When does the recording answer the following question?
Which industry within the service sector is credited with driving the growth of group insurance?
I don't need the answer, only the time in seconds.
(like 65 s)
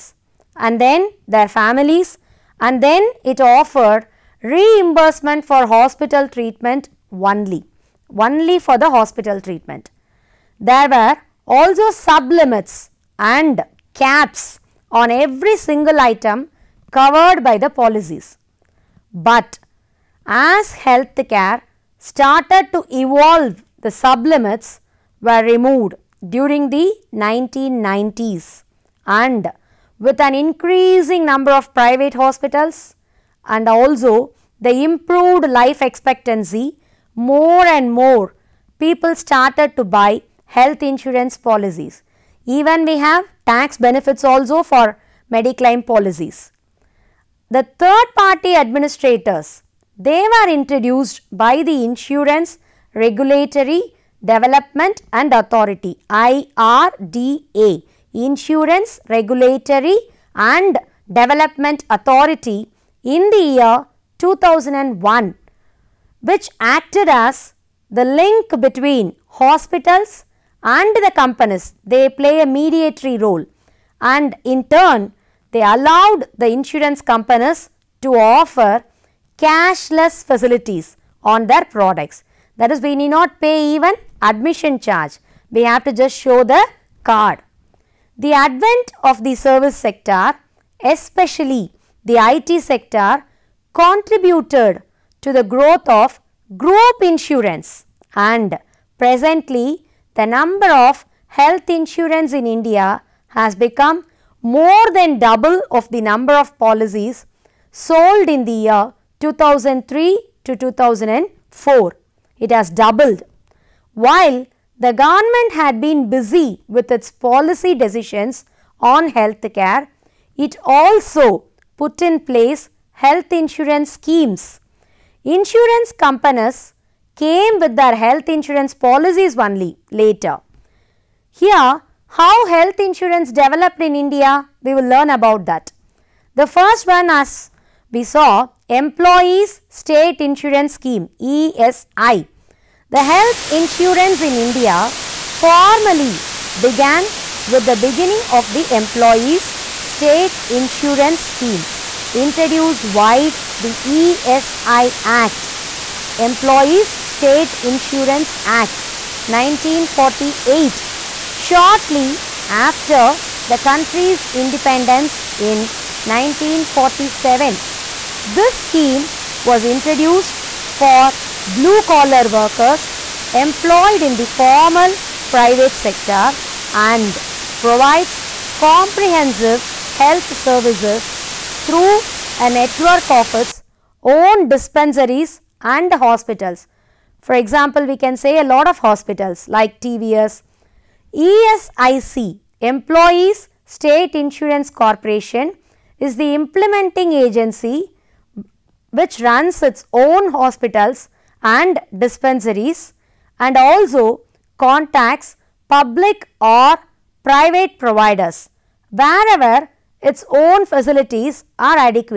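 92 s.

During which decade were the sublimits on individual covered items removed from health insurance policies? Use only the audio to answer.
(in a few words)
1990s.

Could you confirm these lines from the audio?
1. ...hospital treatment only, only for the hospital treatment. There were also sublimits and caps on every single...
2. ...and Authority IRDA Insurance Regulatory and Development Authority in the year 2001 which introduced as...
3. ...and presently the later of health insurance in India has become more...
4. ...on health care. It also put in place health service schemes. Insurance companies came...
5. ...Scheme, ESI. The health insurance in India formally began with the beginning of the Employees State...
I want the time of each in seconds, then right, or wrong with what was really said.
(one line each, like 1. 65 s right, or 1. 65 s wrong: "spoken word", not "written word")
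1. 5 s right
2. 55 s wrong: "acted", not "introduced"
3. 98 s wrong: "number", not "later"
4. 118 s wrong: "insurance", not "service"
5. 140 s right.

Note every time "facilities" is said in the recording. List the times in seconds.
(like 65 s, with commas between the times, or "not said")
80 s, 210 s.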